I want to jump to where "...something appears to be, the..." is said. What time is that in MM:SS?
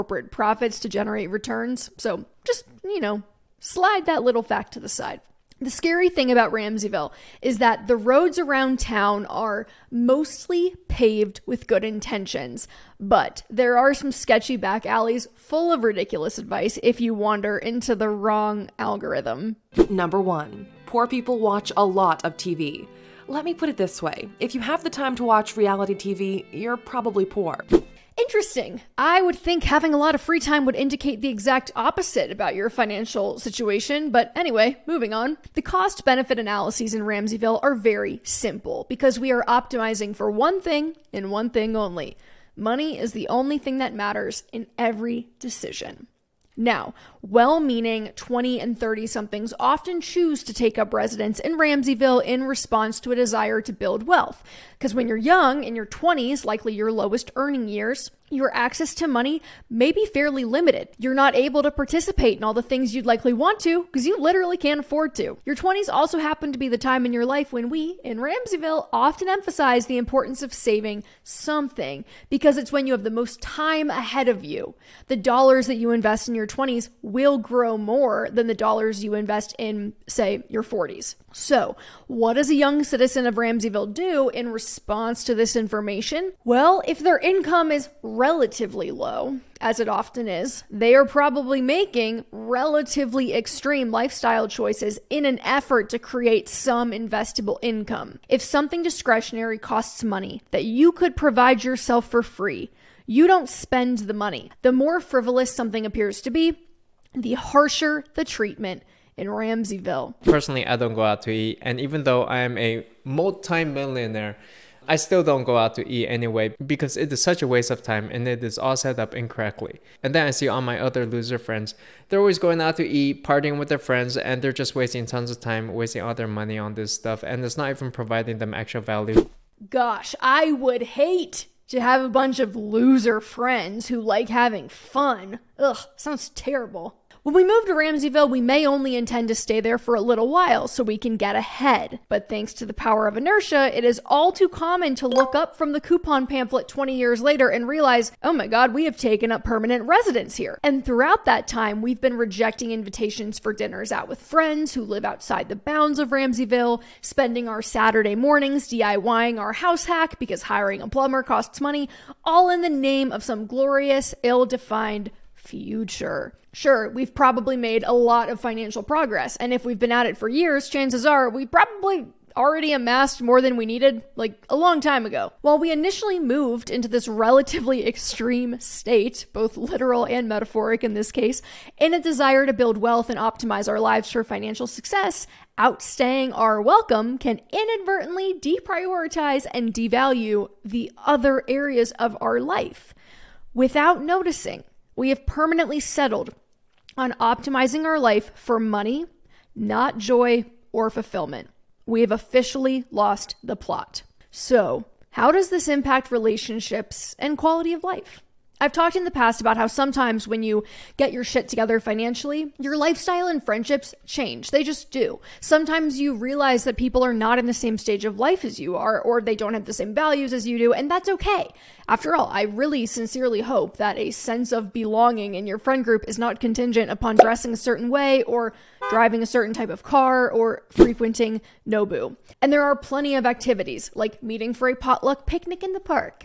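01:45.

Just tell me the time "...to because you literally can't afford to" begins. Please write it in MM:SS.
01:03.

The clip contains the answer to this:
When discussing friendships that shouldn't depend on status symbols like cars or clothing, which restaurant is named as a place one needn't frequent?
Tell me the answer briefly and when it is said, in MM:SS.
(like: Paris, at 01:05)
Nobu, at 03:51.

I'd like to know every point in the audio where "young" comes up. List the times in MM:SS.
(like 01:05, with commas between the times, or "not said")
00:55, 01:22.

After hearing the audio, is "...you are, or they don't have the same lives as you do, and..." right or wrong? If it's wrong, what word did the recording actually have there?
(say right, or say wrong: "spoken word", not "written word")
wrong: "values", not "lives".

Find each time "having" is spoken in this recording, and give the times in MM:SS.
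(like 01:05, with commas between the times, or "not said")
00:29, 02:14.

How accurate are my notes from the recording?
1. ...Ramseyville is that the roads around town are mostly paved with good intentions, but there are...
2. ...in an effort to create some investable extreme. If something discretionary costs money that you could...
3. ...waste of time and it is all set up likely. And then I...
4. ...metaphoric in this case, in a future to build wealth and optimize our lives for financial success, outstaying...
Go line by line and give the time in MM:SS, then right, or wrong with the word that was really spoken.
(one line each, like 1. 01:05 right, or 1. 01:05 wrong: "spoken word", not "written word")
1. 00:06 right
2. 01:35 wrong: "income", not "extreme"
3. 01:57 wrong: "incorrectly", not "likely"
4. 03:00 wrong: "desire", not "future".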